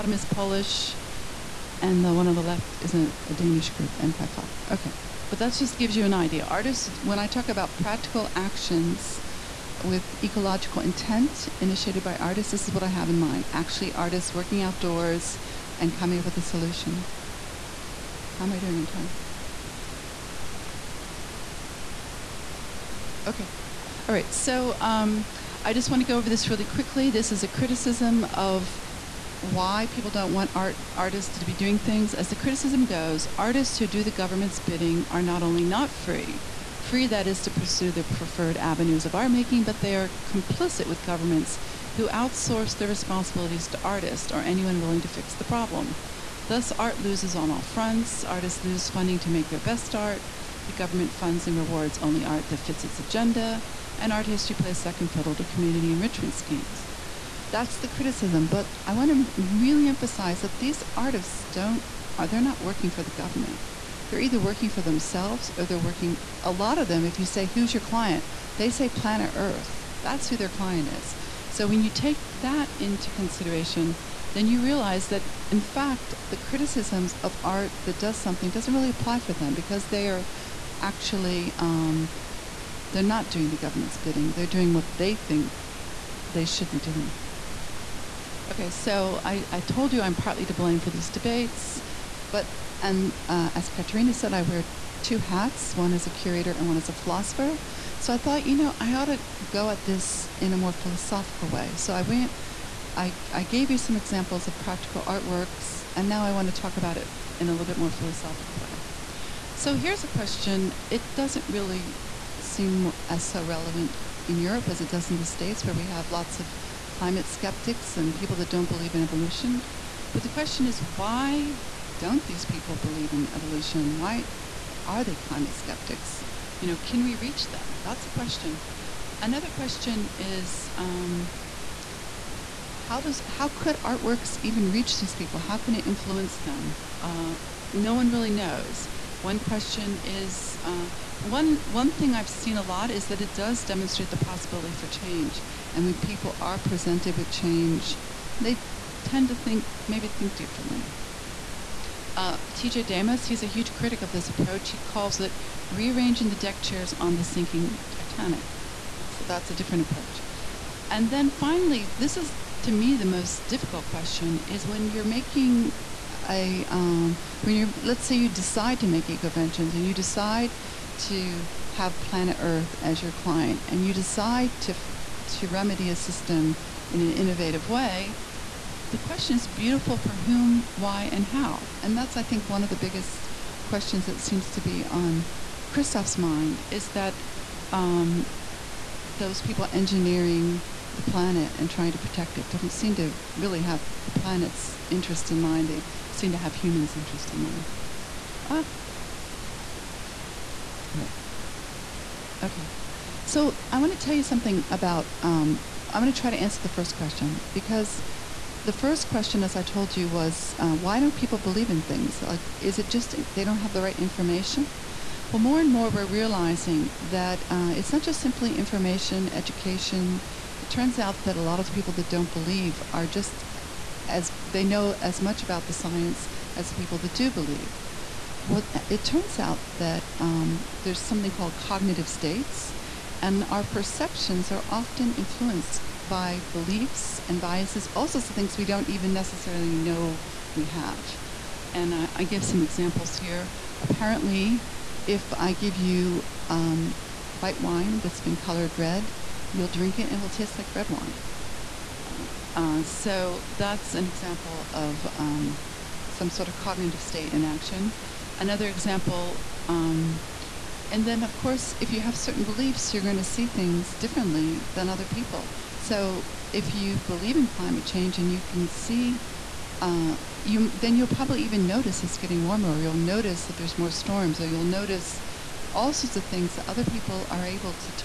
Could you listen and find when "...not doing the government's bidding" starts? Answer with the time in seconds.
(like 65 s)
83 s.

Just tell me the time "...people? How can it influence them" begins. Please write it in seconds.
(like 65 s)
135 s.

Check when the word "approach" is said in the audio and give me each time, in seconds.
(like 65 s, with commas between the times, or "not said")
154 s, 159 s.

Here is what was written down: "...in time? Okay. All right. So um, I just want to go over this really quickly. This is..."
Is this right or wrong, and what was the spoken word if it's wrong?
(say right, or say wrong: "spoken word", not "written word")
right.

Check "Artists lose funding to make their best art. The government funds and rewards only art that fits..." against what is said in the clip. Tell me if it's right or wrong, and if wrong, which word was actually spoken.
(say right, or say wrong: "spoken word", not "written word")
right.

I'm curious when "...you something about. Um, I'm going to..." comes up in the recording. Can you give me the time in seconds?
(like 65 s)
204 s.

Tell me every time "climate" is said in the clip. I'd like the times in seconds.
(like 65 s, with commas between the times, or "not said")
116 s, 125 s, 267 s.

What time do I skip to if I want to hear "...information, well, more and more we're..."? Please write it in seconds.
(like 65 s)
213 s.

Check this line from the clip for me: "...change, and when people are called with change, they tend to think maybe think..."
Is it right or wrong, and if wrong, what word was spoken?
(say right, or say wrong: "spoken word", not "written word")
wrong: "presented", not "called".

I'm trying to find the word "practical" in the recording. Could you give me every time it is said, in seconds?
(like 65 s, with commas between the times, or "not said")
7 s, 104 s.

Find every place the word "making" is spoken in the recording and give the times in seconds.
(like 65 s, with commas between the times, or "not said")
39 s, 165 s.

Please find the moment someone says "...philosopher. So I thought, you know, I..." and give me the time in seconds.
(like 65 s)
96 s.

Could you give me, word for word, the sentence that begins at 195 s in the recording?
They seem to have humans' interest in mind.